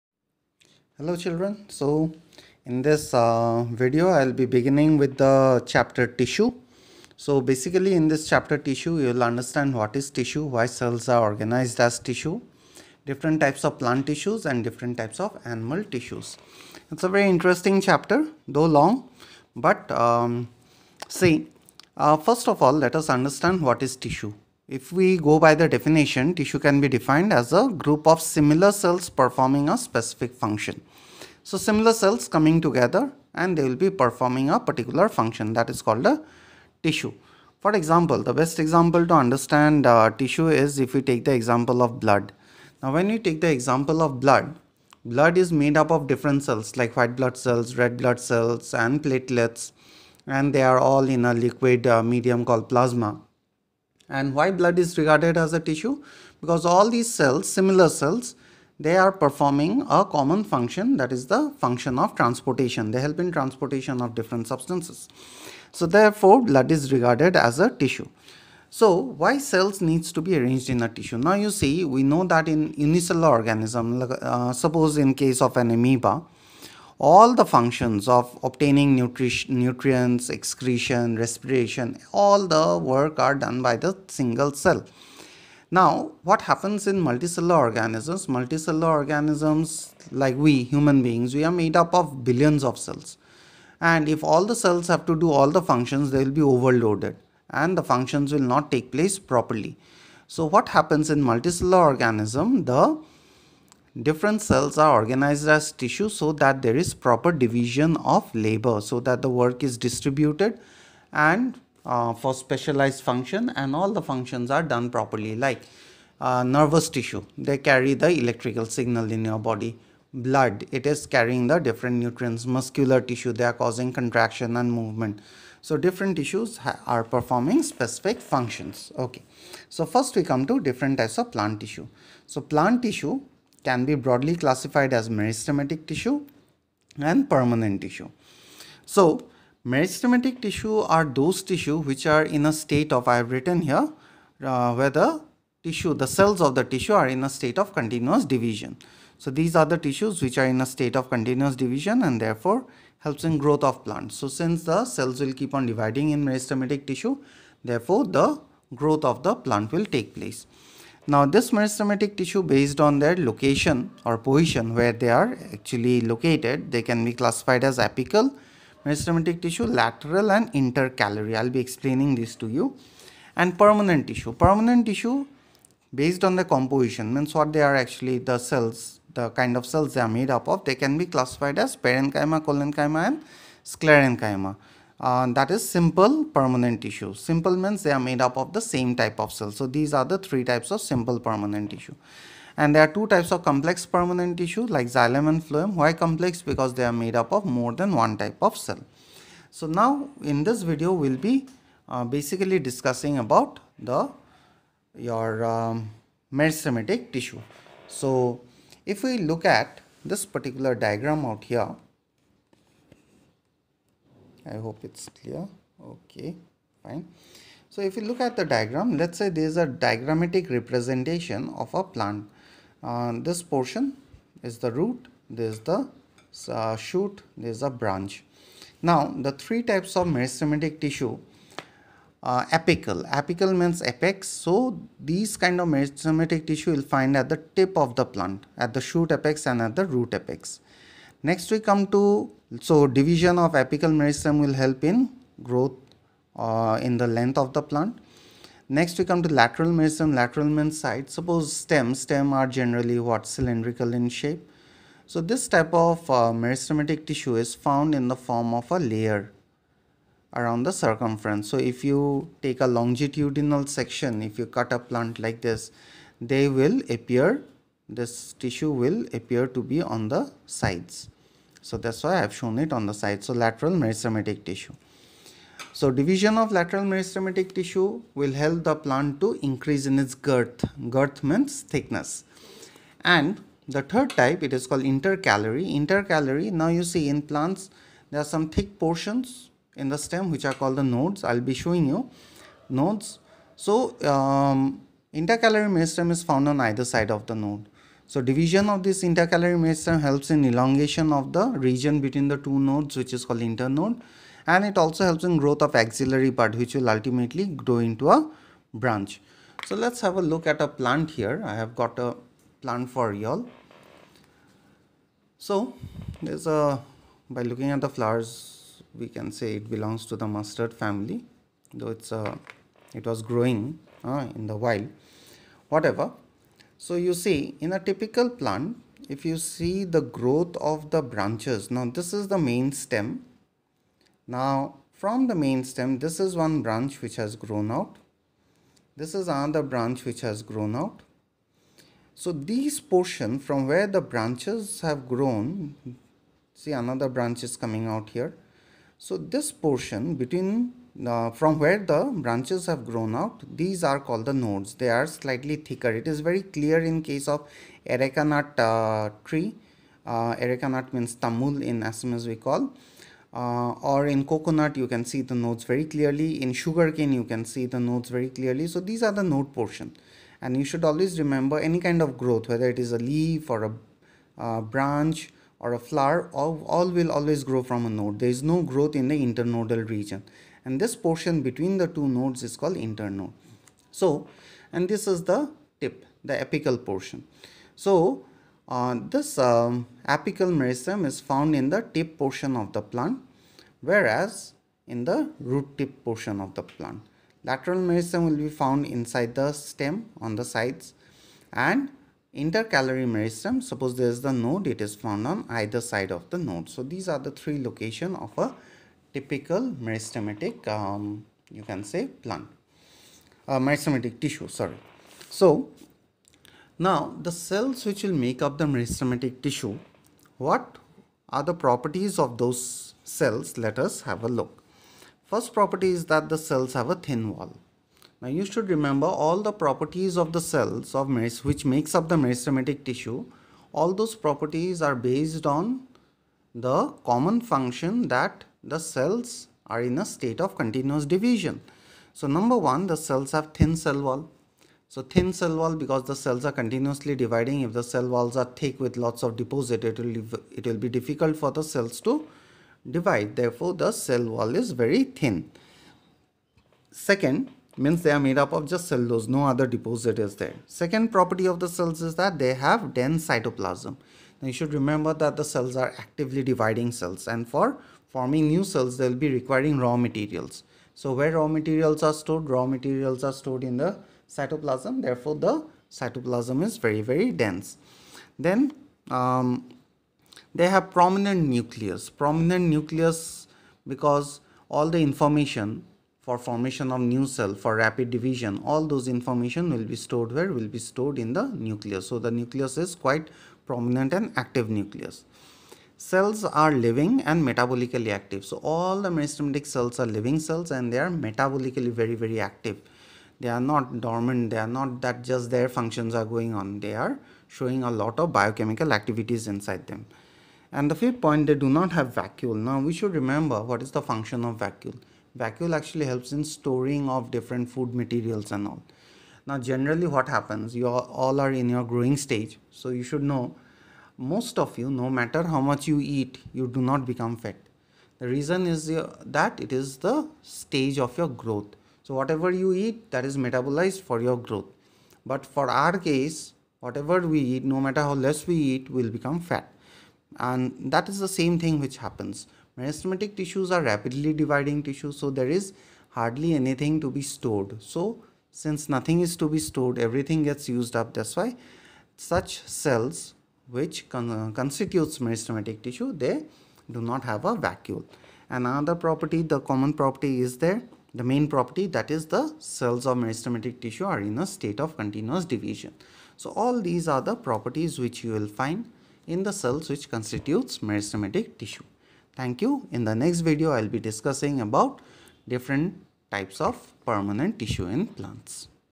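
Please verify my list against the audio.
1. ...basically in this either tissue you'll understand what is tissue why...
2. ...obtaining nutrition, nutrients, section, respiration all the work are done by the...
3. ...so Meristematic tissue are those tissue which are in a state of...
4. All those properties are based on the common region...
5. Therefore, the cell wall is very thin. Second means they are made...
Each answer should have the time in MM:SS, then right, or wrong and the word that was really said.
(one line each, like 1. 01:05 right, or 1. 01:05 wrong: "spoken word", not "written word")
1. 00:07 wrong: "chapter", not "either"
2. 01:18 wrong: "excretion", not "section"
3. 02:18 right
4. 07:13 wrong: "function", not "region"
5. 07:33 right.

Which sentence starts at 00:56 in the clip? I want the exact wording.
Because all these cells, similar cells, they are performing a common function that is the function of transportation.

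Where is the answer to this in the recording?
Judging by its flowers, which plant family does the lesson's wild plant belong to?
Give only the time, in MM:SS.
05:20.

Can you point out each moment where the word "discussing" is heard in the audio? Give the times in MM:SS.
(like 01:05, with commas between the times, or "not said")
03:22, 09:33.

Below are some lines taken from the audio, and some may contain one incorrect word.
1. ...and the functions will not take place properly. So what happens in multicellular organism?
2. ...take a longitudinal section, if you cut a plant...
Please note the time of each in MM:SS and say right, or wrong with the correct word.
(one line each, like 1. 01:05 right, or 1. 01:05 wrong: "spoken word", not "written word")
1. 01:37 right
2. 04:22 right.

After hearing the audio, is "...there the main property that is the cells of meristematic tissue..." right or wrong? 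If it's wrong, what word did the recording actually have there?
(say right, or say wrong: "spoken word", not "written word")
right.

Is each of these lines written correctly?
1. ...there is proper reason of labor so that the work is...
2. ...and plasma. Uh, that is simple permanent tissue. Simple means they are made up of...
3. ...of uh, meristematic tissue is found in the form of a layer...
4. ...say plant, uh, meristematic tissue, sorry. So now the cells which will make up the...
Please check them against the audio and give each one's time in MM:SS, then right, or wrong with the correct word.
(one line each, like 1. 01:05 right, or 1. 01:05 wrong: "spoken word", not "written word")
1. 01:46 wrong: "division", not "reason"
2. 03:03 wrong: "sclerenchyma", not "plasma"
3. 04:15 right
4. 06:51 right.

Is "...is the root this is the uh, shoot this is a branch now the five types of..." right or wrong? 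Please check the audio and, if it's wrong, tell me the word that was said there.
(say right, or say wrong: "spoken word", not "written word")
wrong: "three", not "five".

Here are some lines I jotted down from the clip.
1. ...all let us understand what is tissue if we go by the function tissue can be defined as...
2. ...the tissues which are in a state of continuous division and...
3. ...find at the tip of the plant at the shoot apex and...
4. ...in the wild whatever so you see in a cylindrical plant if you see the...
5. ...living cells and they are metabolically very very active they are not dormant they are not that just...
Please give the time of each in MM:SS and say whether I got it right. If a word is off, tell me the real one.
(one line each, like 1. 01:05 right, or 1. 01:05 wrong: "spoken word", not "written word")
1. 00:22 wrong: "definition", not "function"
2. 02:29 right
3. 03:56 right
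4. 05:24 wrong: "typical", not "cylindrical"
5. 08:20 right.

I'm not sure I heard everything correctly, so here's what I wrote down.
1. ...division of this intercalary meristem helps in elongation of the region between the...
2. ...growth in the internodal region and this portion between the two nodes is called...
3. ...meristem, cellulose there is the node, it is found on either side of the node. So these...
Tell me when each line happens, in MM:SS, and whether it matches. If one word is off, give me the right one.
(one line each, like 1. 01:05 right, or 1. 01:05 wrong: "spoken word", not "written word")
1. 04:58 right
2. 06:18 right
3. 06:43 wrong: "suppose", not "cellulose".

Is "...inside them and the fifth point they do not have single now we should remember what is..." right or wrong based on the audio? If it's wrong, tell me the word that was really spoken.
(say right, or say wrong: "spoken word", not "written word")
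wrong: "vacuole", not "single".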